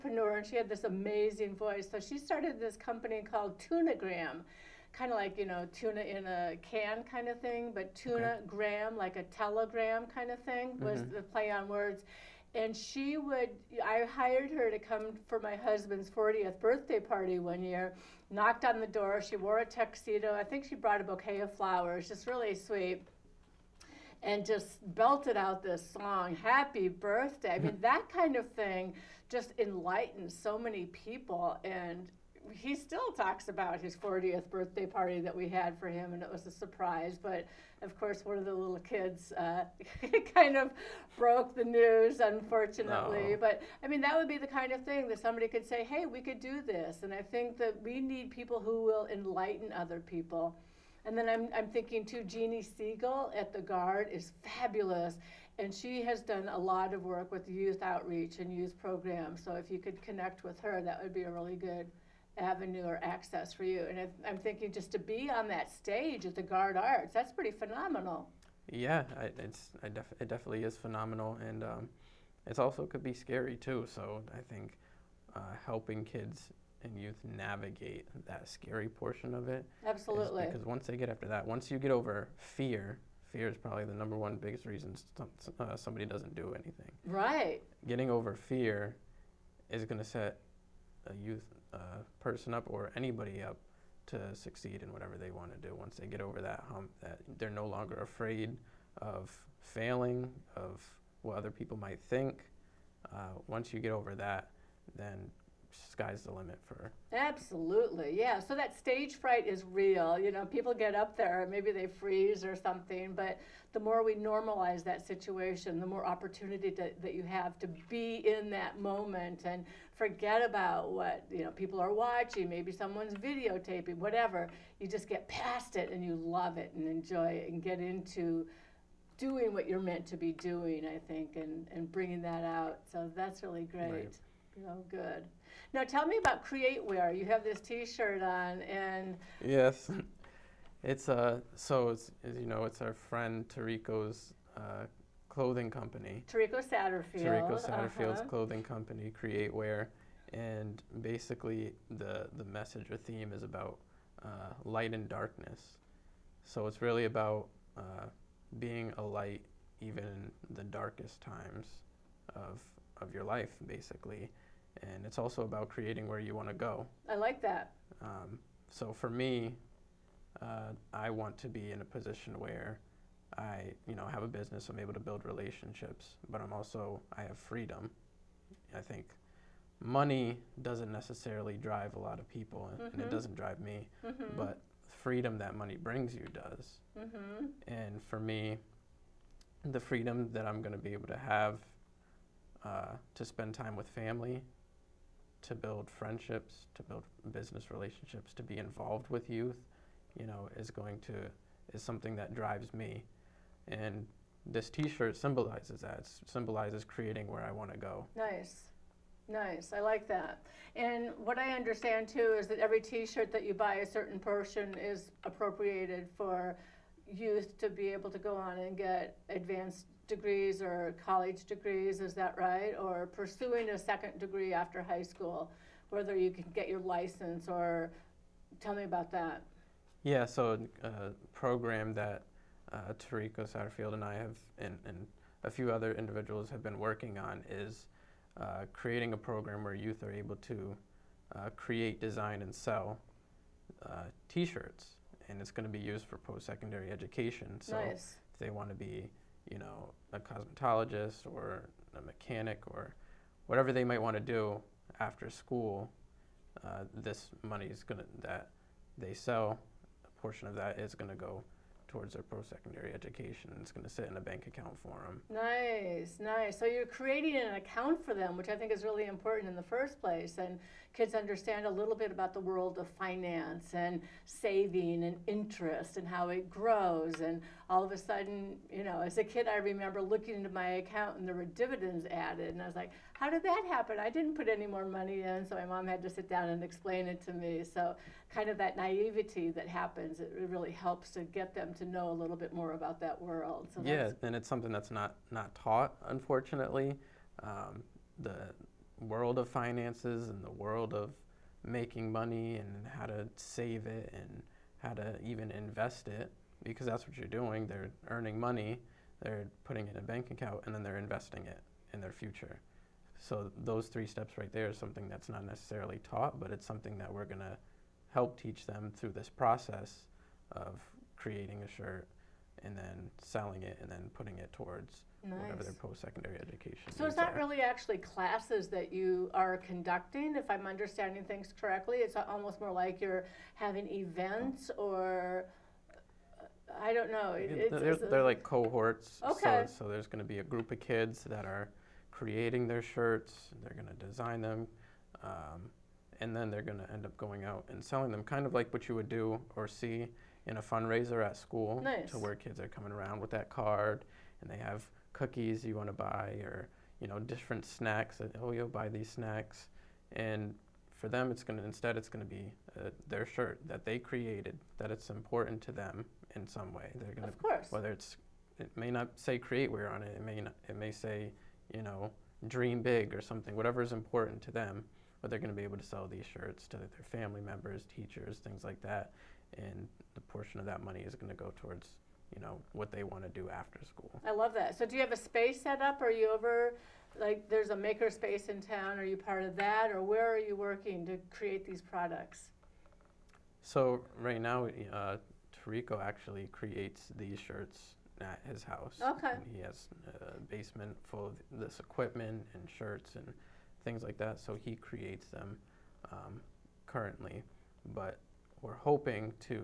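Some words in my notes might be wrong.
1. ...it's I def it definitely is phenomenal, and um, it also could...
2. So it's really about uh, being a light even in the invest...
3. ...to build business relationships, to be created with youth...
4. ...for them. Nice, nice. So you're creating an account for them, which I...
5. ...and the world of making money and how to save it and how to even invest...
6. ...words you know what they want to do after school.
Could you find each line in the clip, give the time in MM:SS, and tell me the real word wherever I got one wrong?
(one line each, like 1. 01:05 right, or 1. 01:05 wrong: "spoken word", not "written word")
1. 01:09 right
2. 02:36 wrong: "darkest", not "invest"
3. 03:16 wrong: "involved", not "created"
4. 04:24 right
5. 05:00 right
6. 06:21 wrong: "towards", not "words".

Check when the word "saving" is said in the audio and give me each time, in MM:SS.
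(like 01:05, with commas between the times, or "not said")
04:34.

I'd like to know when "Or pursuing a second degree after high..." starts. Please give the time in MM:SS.
03:42.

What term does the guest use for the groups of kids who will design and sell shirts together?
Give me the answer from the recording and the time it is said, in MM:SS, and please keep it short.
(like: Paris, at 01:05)
cohorts, at 05:38.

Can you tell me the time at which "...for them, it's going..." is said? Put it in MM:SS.
06:00.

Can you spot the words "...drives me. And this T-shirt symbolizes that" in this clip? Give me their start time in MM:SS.
03:22.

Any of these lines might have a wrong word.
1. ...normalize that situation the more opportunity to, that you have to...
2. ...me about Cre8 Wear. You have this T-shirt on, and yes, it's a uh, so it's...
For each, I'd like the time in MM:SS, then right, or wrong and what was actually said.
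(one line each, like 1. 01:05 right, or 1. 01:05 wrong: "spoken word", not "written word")
1. 01:54 right
2. 02:16 right.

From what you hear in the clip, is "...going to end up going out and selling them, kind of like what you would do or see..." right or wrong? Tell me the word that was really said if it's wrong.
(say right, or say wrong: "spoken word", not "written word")
right.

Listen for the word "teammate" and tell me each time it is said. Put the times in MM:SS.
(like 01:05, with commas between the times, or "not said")
not said.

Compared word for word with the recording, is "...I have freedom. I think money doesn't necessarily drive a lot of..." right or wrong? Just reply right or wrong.
right.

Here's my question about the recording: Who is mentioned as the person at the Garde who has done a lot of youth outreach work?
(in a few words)
Jeannie Siegel.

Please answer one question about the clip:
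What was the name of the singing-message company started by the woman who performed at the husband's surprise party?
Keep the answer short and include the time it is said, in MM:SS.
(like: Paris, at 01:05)
Tunagram, at 00:03.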